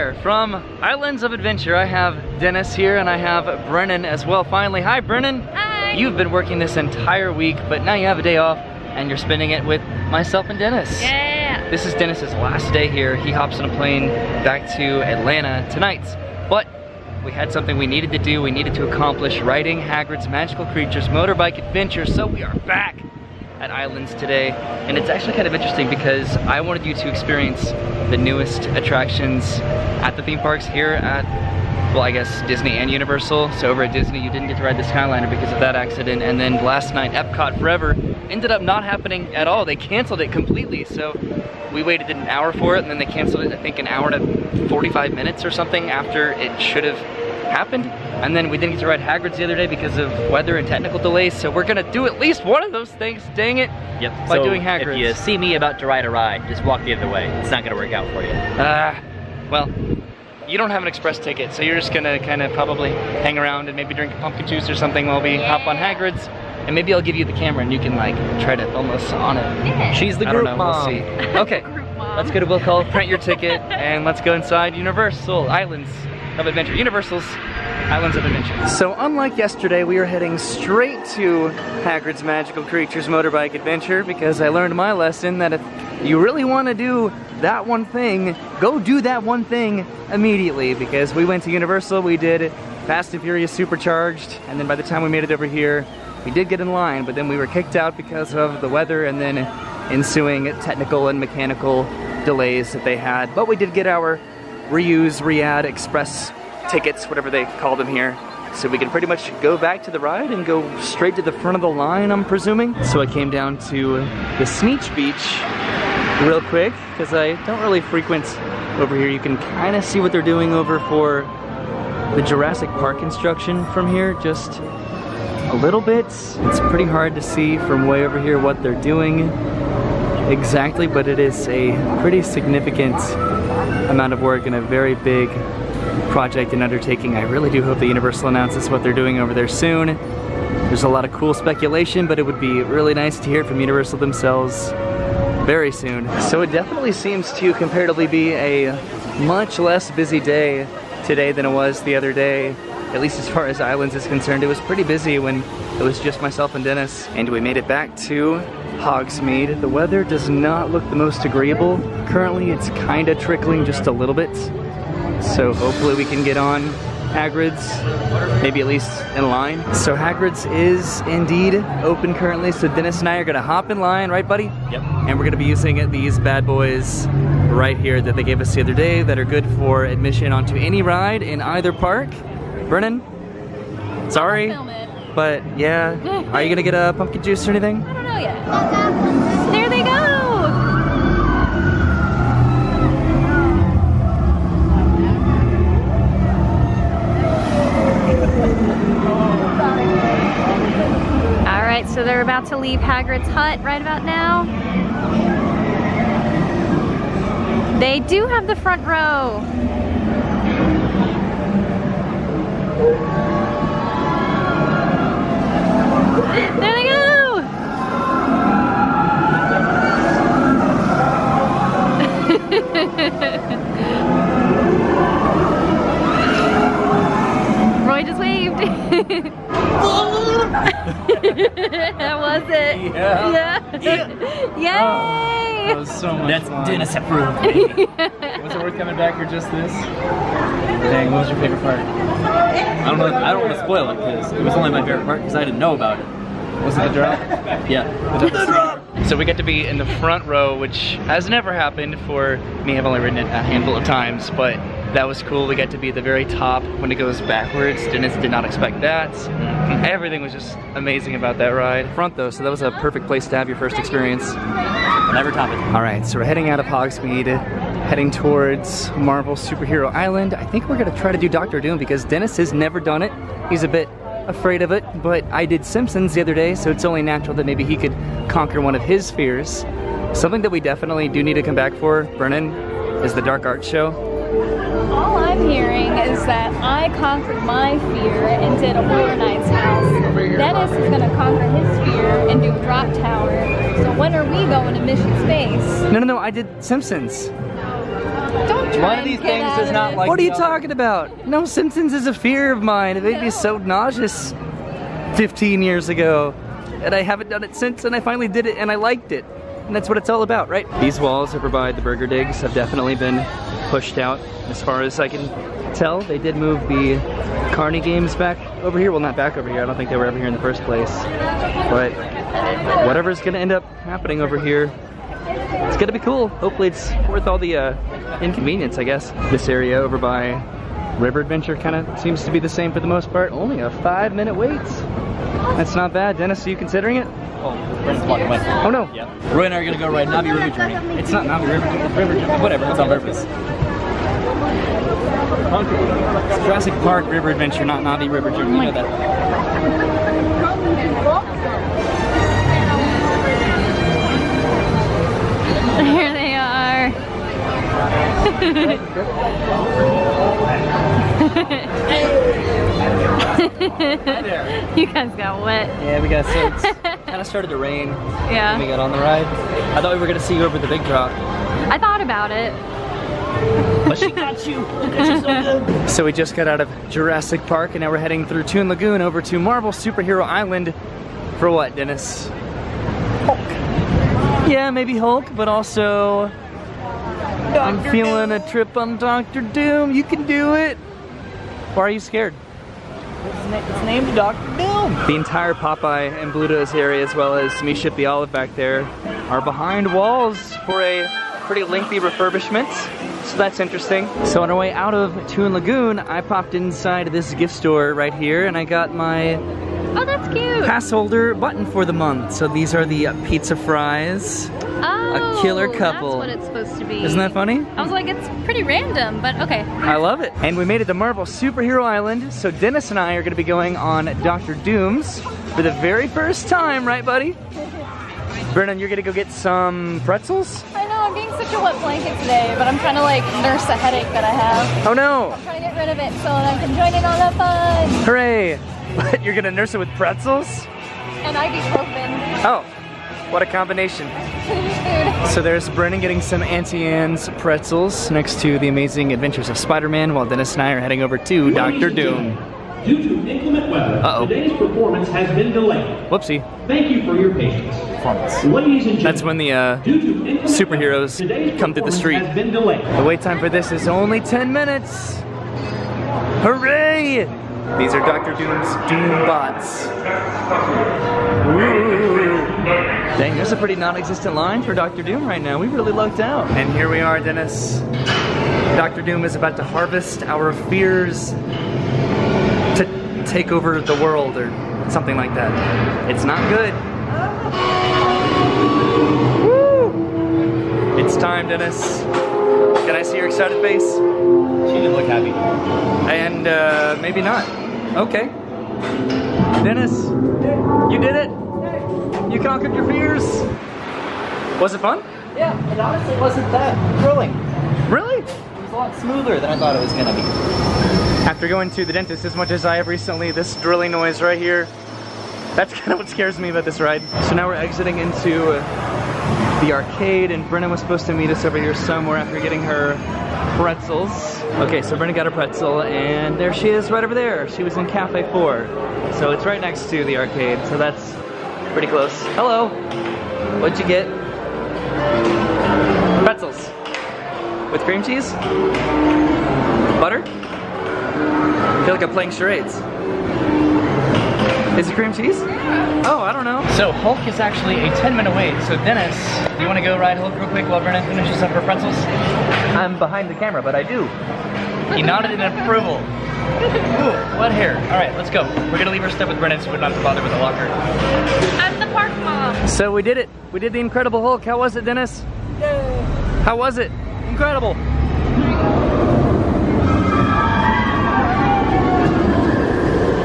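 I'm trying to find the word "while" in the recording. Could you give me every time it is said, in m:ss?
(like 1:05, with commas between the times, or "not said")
1:05, 7:30, 9:10.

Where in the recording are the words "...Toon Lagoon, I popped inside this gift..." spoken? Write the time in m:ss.
6:45.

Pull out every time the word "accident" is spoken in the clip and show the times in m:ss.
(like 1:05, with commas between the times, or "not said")
0:35.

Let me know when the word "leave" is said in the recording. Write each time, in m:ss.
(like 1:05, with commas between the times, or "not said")
3:22, 9:18.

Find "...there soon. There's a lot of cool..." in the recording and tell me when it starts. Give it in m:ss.
2:19.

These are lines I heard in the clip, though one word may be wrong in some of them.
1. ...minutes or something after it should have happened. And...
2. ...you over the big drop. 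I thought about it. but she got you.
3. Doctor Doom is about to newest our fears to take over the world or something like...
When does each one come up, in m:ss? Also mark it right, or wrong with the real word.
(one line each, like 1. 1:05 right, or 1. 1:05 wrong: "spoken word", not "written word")
1. 0:45 right
2. 6:10 right
3. 7:58 wrong: "harvest", not "newest".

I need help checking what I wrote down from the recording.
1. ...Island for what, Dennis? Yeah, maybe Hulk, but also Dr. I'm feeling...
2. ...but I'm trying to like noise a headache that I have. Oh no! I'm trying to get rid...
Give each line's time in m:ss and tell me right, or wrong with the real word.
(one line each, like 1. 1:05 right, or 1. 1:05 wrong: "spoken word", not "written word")
1. 6:20 right
2. 7:12 wrong: "nurse", not "noise".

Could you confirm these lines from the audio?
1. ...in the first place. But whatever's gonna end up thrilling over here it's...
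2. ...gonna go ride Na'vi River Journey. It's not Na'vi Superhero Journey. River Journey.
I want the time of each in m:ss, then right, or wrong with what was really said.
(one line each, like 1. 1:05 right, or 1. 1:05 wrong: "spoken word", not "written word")
1. 5:20 wrong: "happening", not "thrilling"
2. 5:39 wrong: "River", not "Superhero".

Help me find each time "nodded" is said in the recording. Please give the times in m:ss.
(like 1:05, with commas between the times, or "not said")
9:15.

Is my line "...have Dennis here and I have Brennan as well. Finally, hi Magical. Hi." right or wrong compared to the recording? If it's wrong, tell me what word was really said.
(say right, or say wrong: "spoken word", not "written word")
wrong: "Brennan", not "Magical".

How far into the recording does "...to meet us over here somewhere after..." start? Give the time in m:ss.
8:41.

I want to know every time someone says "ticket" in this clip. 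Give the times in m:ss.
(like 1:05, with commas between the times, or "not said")
1:01, 1:13, 1:46.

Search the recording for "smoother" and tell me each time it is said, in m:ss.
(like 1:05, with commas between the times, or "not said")
8:28.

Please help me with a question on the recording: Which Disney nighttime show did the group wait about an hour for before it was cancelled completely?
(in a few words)
Epcot Forever.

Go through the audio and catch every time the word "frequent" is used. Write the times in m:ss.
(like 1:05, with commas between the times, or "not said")
1:57.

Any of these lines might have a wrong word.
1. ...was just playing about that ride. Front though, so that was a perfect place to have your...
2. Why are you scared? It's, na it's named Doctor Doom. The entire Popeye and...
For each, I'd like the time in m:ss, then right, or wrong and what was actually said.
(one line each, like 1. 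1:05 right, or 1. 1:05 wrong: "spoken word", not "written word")
1. 4:20 wrong: "amazing", not "playing"
2. 6:31 right.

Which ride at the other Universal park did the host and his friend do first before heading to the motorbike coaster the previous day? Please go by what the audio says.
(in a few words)
Fast and Furious Supercharged.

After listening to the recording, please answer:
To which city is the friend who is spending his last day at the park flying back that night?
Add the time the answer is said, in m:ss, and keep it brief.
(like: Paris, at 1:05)
Atlanta, at 0:15.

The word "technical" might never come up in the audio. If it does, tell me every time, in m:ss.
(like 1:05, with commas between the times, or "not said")
0:50, 1:40.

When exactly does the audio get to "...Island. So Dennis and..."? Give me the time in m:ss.
7:01.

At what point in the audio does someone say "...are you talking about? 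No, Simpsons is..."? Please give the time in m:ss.
5:00.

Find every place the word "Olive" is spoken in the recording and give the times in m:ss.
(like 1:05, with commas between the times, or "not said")
6:38.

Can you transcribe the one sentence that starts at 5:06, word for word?
And I haven't done it since, and I finally did it, and I liked it.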